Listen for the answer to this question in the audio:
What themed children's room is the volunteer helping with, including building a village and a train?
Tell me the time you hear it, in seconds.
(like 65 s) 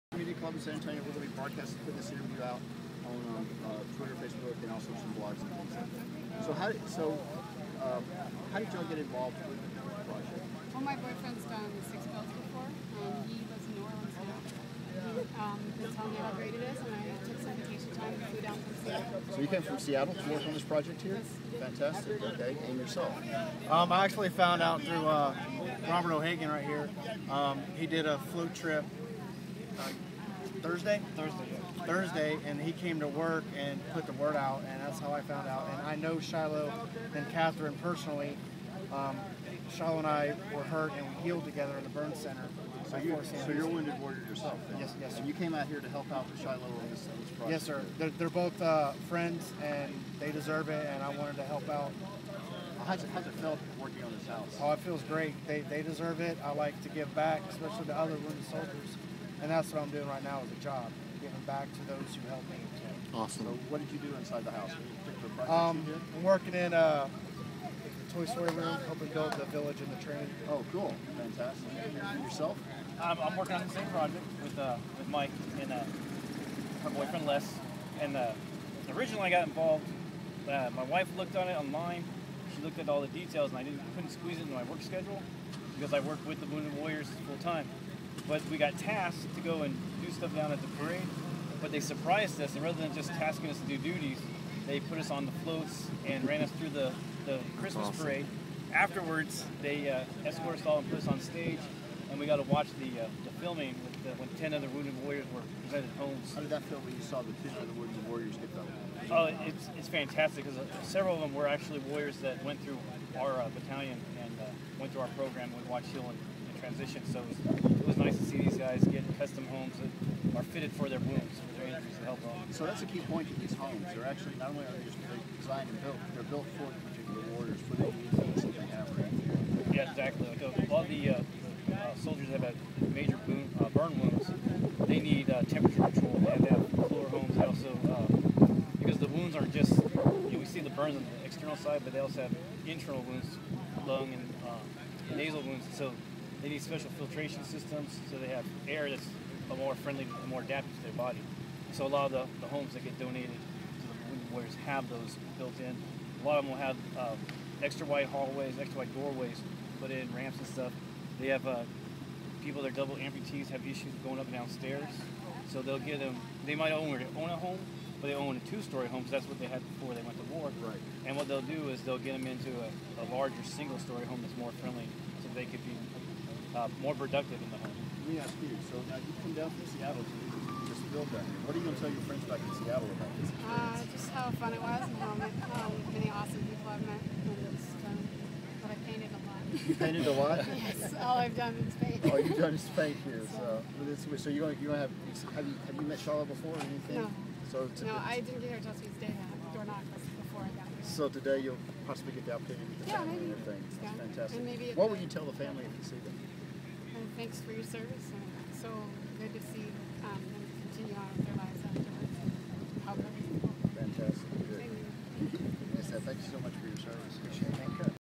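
68 s.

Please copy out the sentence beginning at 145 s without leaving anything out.
So they need special filtration systems so they have air that's more friendly, more adapted to their body.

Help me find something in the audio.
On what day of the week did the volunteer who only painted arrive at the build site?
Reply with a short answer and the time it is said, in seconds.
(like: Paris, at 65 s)
Tuesday, at 198 s.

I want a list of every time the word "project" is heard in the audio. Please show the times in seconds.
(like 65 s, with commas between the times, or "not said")
9 s, 20 s, 47 s, 73 s.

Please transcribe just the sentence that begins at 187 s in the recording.
And just, I painted a lot.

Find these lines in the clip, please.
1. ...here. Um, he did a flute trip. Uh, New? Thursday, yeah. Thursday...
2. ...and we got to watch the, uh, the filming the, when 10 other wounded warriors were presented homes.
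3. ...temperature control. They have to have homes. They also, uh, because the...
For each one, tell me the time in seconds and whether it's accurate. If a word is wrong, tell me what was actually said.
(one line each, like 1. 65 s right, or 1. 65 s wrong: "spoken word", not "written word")
1. 26 s wrong: "Thursday", not "New"
2. 102 s right
3. 135 s right.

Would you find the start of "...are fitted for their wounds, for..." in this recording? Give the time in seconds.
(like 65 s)
120 s.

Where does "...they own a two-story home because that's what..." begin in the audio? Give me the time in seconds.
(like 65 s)
168 s.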